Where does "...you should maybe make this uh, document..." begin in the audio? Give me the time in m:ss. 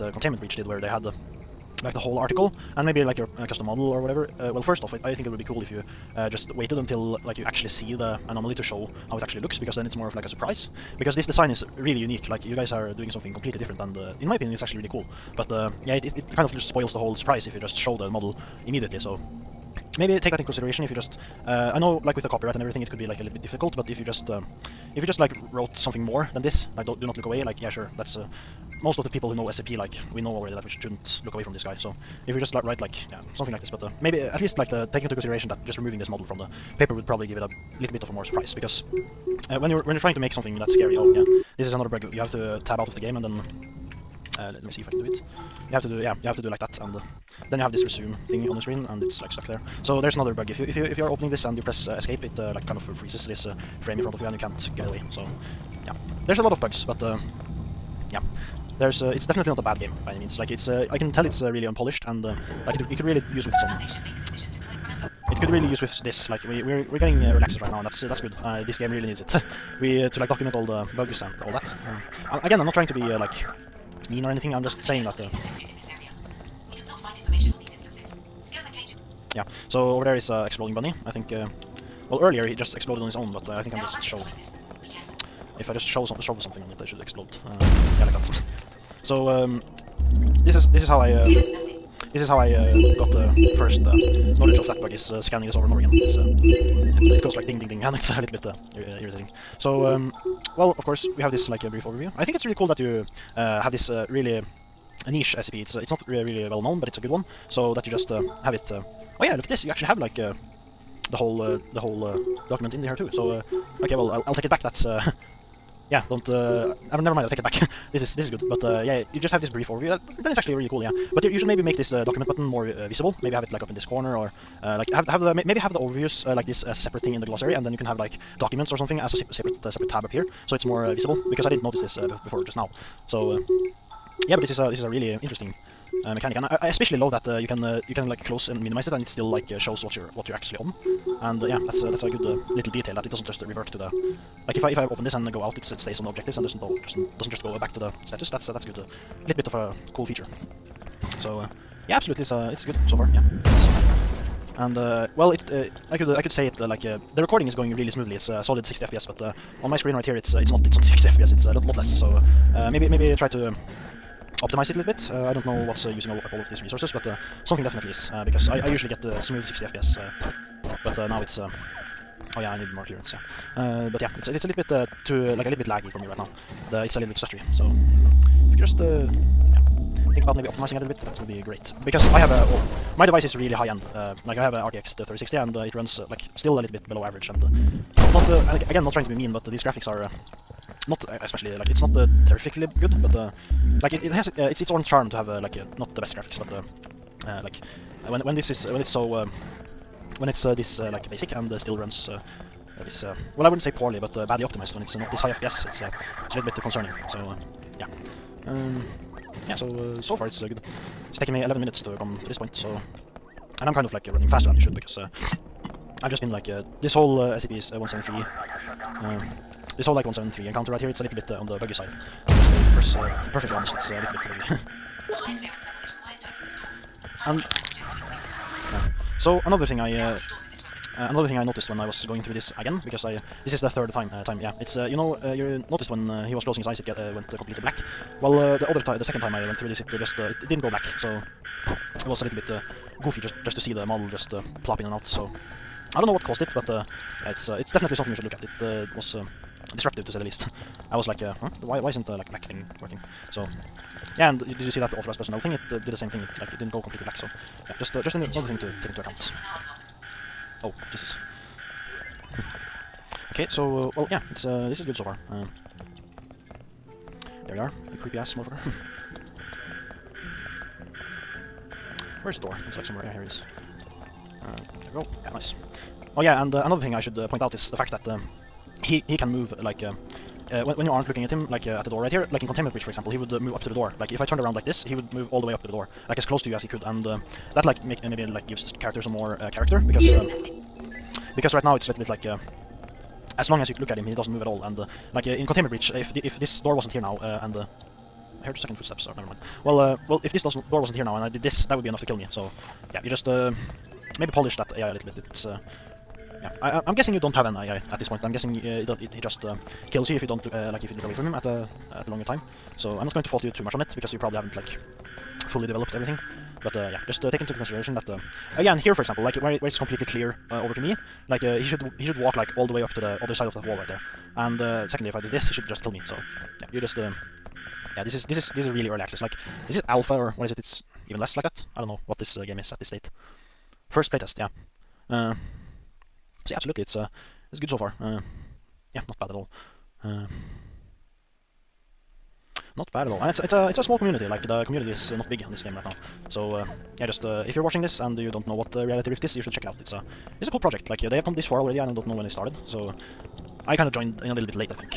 2:01.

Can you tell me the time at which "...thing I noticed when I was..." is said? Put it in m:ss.
3:51.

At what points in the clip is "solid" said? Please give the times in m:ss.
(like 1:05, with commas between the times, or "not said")
2:38.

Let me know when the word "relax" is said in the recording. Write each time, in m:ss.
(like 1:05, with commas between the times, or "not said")
not said.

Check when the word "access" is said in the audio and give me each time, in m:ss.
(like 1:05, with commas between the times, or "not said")
1:07, 5:29.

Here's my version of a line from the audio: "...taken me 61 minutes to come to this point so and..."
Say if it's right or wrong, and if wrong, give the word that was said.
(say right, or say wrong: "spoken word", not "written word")
wrong: "11", not "61".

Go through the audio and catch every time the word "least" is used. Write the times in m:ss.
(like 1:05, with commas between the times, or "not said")
0:34, 4:10.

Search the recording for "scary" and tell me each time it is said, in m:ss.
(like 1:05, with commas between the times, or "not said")
0:40.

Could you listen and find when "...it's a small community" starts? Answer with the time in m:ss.
5:43.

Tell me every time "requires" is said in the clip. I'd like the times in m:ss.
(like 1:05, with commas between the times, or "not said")
not said.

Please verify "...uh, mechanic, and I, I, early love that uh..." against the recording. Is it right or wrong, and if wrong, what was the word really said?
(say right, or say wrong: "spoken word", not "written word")
wrong: "especially", not "early".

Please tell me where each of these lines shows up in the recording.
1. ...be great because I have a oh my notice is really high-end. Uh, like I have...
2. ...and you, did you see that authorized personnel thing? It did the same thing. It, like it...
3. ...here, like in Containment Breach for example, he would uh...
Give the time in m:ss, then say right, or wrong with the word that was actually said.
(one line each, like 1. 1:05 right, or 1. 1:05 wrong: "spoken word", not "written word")
1. 3:01 wrong: "device", not "notice"
2. 4:14 right
3. 4:42 right.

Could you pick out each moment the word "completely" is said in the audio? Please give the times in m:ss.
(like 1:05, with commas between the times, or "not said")
0:13, 3:57, 4:16, 5:19.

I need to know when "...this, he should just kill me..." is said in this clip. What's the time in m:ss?
5:25.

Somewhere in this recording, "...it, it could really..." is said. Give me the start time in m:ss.
1:02.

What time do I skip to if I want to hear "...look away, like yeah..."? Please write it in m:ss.
0:27.